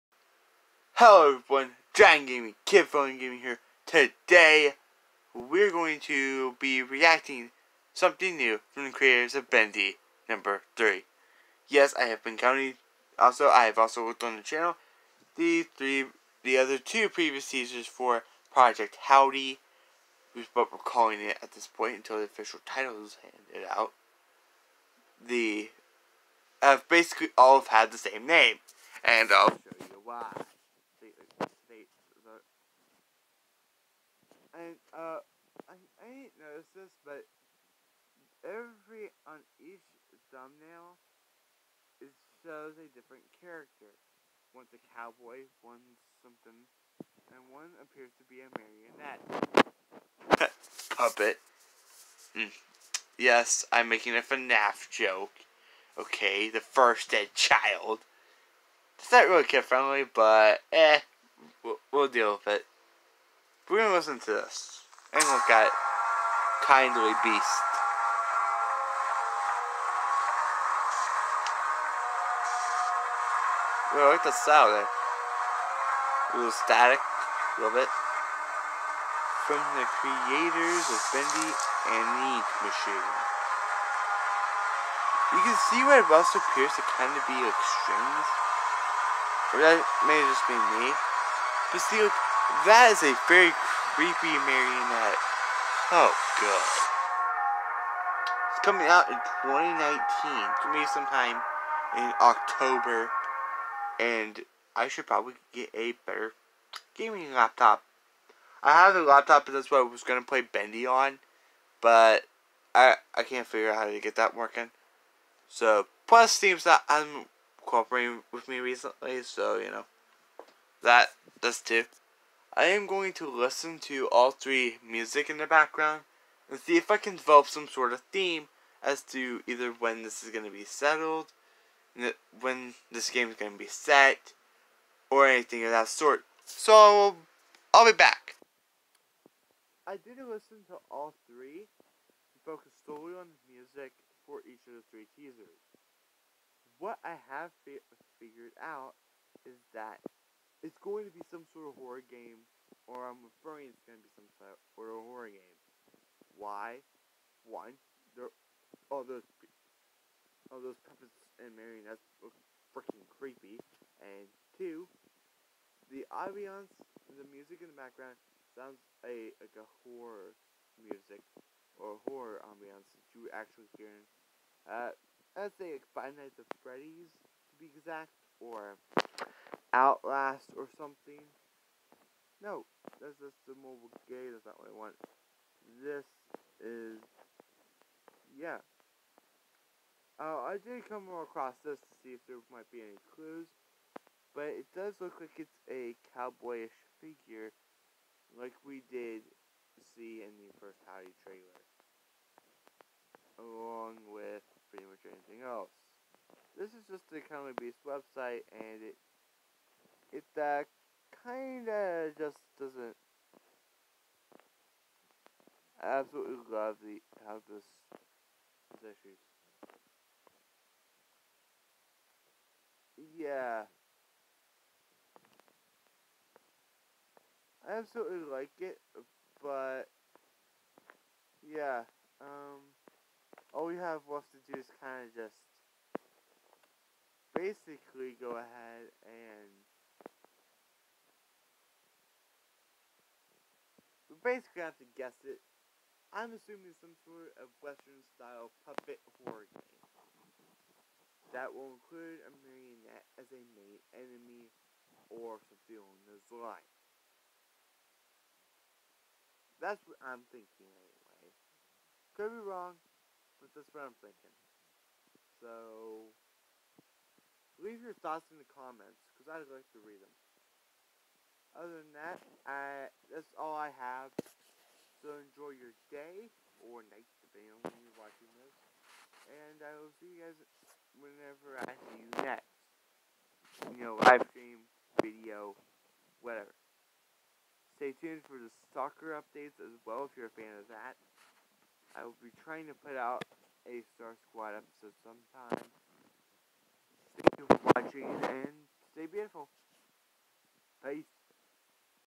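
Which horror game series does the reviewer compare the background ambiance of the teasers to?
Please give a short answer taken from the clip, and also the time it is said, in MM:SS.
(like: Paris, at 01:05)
Five Nights at Freddy's, at 02:55.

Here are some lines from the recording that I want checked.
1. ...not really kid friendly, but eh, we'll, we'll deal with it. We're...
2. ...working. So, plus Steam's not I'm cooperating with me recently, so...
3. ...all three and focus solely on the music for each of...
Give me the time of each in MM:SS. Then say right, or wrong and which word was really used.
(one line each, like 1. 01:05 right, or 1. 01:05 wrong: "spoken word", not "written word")
1. 00:59 right
2. 01:54 right
3. 02:20 right.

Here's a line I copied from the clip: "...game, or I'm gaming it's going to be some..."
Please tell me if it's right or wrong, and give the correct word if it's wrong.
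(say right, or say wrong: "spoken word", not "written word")
wrong: "referring", not "gaming".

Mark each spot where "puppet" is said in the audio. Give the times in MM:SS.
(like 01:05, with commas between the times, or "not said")
00:50, 02:40, 04:08.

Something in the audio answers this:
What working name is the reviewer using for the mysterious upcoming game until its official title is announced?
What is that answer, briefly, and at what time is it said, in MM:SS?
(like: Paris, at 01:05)
Project Howdy, at 00:18.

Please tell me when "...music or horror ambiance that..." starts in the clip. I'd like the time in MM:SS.
02:50.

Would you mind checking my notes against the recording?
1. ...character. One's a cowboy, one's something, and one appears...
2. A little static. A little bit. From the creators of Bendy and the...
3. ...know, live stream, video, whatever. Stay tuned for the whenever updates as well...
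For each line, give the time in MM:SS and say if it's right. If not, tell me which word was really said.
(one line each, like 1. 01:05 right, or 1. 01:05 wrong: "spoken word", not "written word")
1. 00:43 right
2. 01:16 right
3. 04:43 wrong: "soccer", not "whenever".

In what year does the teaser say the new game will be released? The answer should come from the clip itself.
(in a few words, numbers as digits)
2019.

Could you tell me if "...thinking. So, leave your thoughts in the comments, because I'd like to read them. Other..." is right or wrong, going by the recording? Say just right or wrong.
right.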